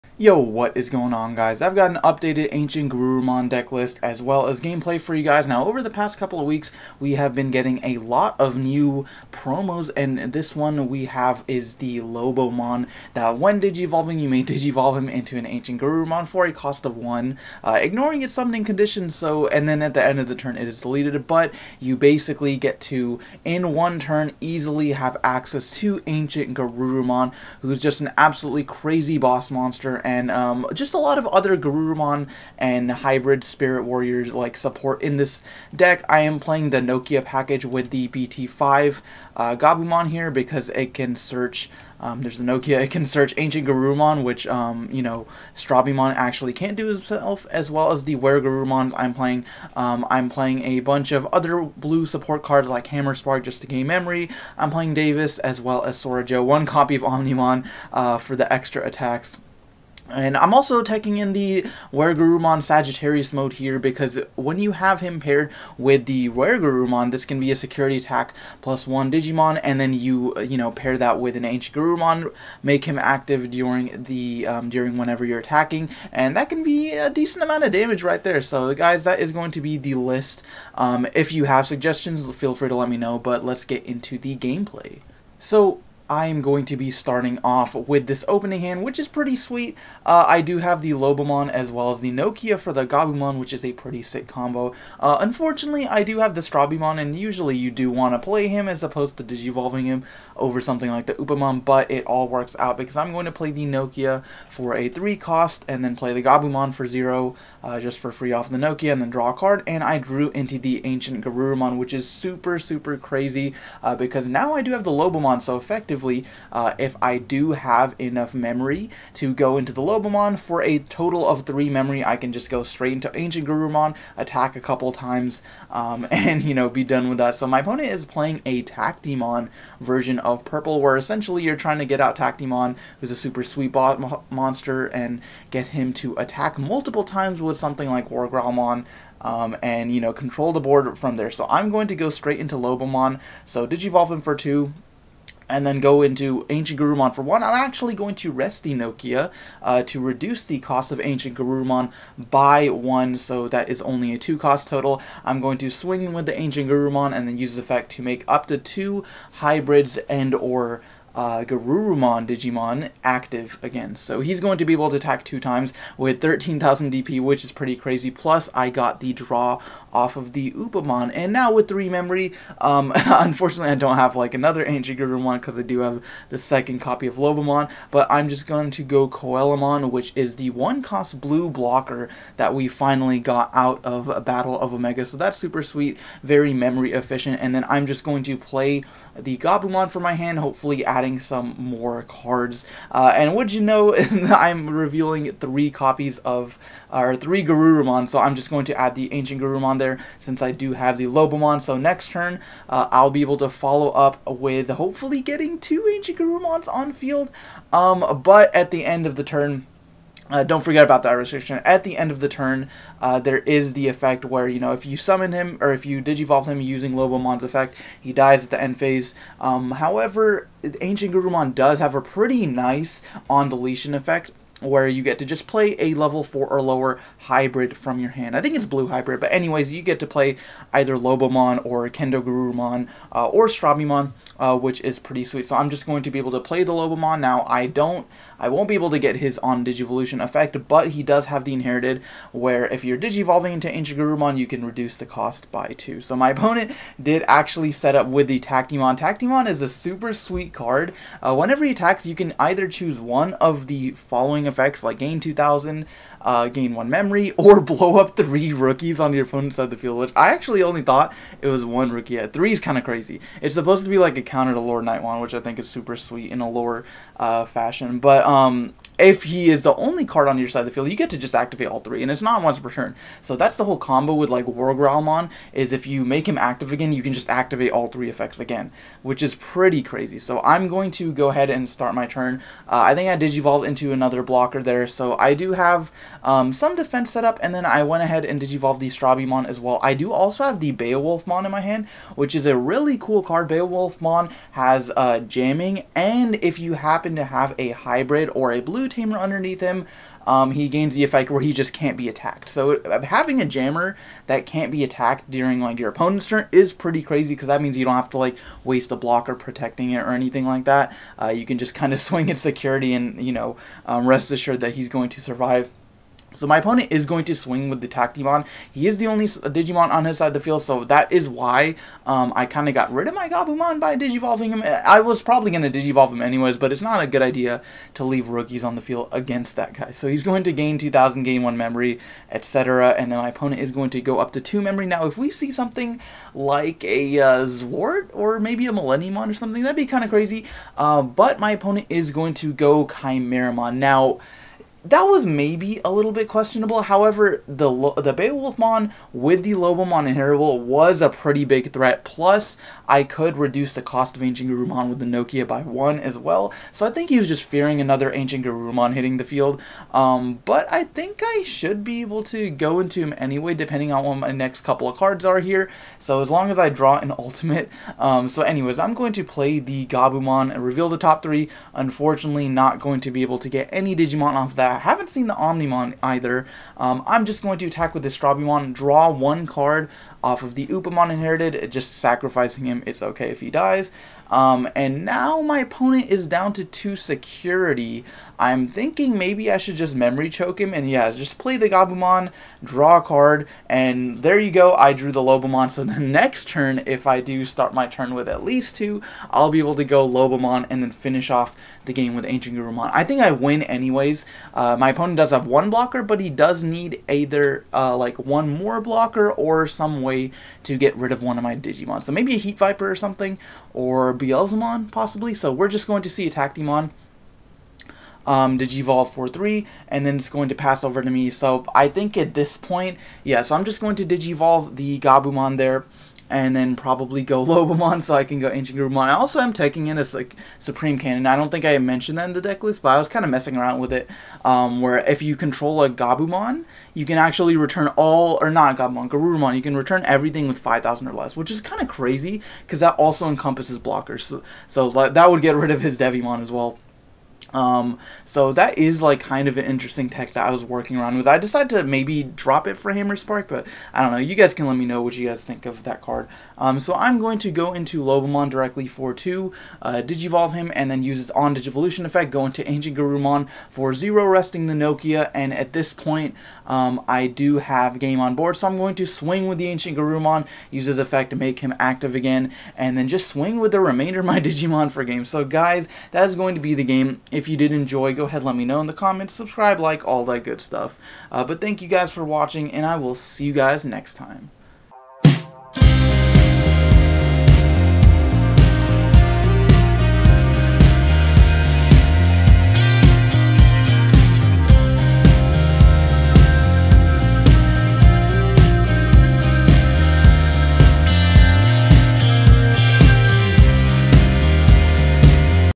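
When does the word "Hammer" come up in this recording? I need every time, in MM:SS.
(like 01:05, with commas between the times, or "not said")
00:52, 07:32.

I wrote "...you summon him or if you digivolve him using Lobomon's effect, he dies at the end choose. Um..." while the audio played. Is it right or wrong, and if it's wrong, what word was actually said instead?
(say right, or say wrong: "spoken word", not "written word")
wrong: "phase", not "choose".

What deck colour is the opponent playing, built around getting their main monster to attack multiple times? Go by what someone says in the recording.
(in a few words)
Purple.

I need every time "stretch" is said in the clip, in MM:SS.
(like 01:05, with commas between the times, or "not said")
not said.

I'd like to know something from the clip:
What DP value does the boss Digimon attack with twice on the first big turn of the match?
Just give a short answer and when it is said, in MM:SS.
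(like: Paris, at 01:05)
13,000, at 02:46.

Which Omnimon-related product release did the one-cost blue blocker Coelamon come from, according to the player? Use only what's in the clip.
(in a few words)
Battle of Omni.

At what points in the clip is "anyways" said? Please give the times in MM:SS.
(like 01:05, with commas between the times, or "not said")
03:49, 05:26, 06:03, 06:08, 06:43.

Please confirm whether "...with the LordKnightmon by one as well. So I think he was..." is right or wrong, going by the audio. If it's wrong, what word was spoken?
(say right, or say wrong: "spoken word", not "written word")
wrong: "Nokia", not "LordKnightmon".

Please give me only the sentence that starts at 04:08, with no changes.
Tactimon is a super sweet card.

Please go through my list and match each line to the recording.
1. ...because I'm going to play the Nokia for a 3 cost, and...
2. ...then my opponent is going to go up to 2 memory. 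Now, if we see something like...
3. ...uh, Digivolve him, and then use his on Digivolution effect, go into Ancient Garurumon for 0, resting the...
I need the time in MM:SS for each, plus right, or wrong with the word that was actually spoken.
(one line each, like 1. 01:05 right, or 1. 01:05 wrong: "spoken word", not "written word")
1. 01:42 right
2. 05:33 right
3. 07:39 right.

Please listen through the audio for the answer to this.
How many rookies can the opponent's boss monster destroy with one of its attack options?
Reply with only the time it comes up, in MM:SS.
04:17.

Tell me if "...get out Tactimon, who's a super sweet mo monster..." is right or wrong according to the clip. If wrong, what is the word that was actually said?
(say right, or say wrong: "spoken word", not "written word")
right.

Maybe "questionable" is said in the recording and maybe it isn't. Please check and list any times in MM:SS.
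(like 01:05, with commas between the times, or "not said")
05:46.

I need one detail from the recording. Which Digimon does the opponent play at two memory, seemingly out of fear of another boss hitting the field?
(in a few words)
Chimeramon.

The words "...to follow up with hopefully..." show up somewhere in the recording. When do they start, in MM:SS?
03:23.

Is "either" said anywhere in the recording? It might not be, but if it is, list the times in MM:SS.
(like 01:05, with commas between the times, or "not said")
03:50, 04:12, 06:16, 06:47.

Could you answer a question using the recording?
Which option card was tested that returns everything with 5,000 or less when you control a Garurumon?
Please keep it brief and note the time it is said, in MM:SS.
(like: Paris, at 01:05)
Supreme Cannon, at 07:10.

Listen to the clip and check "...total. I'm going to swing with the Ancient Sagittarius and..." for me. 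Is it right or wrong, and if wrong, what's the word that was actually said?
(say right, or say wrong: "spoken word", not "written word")
wrong: "Garurumon", not "Sagittarius".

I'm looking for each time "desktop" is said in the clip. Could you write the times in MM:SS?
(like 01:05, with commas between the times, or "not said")
not said.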